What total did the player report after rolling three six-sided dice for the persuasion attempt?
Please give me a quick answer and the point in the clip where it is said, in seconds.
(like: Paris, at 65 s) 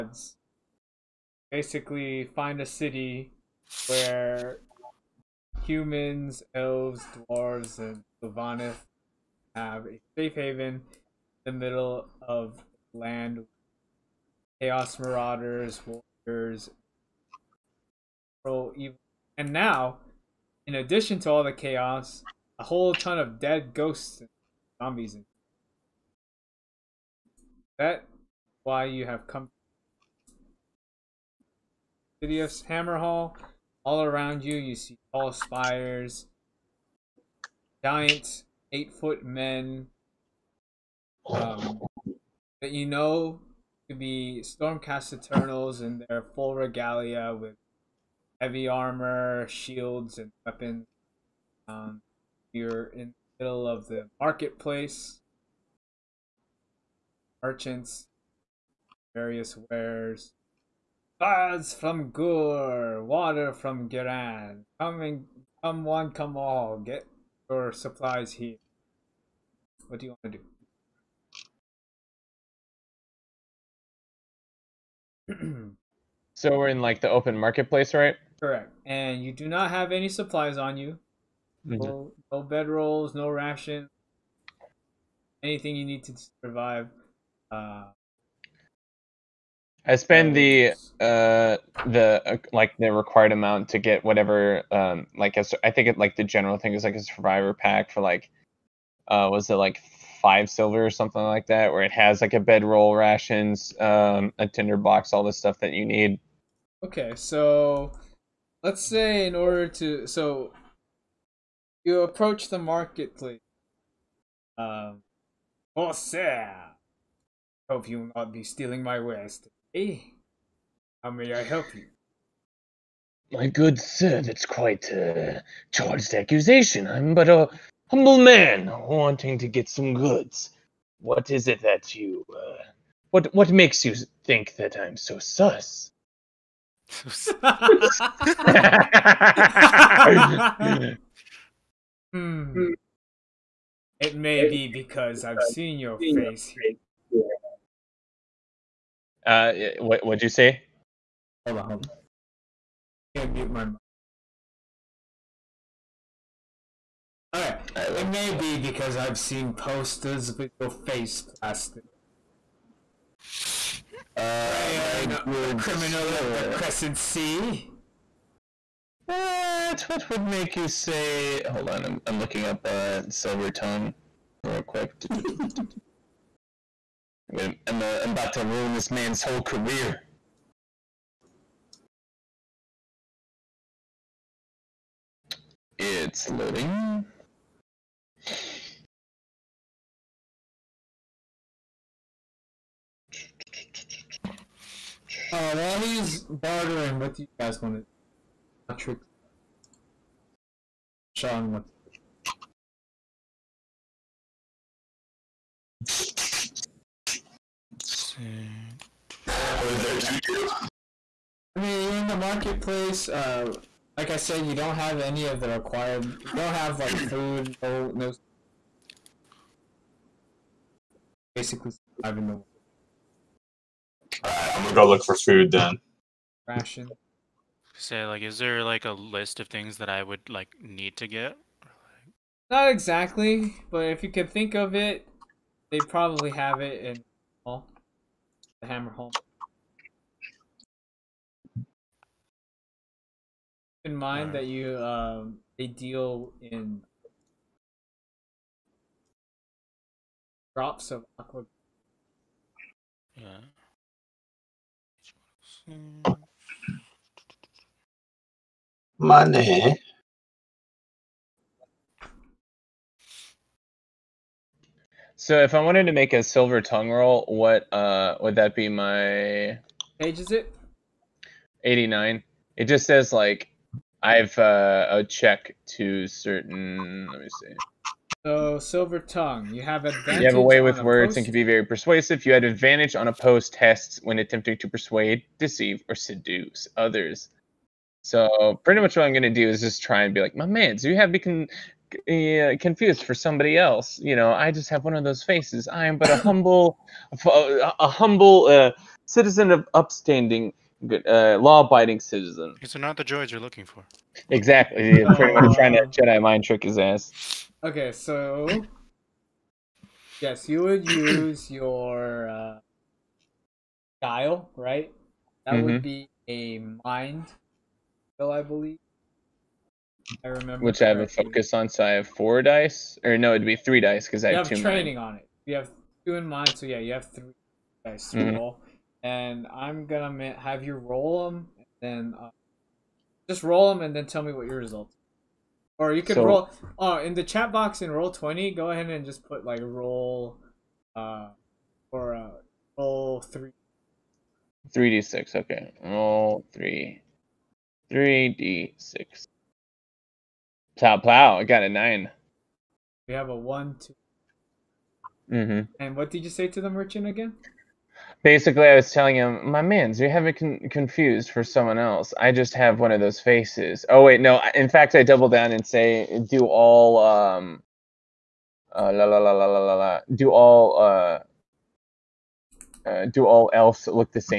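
9, at 351 s.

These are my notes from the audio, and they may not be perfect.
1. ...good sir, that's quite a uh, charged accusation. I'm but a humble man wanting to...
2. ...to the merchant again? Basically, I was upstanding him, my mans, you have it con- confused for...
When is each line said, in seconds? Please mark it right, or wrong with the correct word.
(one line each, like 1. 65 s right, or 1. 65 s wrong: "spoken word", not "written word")
1. 123 s right
2. 356 s wrong: "telling", not "upstanding".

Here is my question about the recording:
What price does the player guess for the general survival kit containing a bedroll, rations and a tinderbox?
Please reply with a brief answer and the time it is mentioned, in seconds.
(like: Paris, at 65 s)
5 silver, at 100 s.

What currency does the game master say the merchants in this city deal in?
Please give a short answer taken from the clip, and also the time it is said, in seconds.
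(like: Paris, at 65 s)
drops of aqua, at 250 s.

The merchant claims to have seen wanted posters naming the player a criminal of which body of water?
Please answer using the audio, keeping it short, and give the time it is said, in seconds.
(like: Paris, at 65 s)
Crescent Sea, at 166 s.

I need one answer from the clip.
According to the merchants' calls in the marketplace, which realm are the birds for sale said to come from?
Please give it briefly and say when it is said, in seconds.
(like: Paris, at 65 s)
Ghur, at 62 s.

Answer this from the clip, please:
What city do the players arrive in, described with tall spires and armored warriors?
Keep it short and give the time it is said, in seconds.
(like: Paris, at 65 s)
Hammerhal, at 32 s.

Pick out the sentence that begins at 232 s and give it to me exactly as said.
Not exactly, but if you can think of it, they probably have it in all hammer home.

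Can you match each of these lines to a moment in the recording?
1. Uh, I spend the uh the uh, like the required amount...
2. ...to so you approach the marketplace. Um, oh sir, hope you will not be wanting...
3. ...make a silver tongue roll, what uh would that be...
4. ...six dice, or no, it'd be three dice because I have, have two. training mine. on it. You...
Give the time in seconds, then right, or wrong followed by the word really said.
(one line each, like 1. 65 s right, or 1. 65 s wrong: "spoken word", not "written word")
1. 87 s right
2. 109 s wrong: "stealing", not "wanting"
3. 265 s right
4. 322 s wrong: "four", not "six".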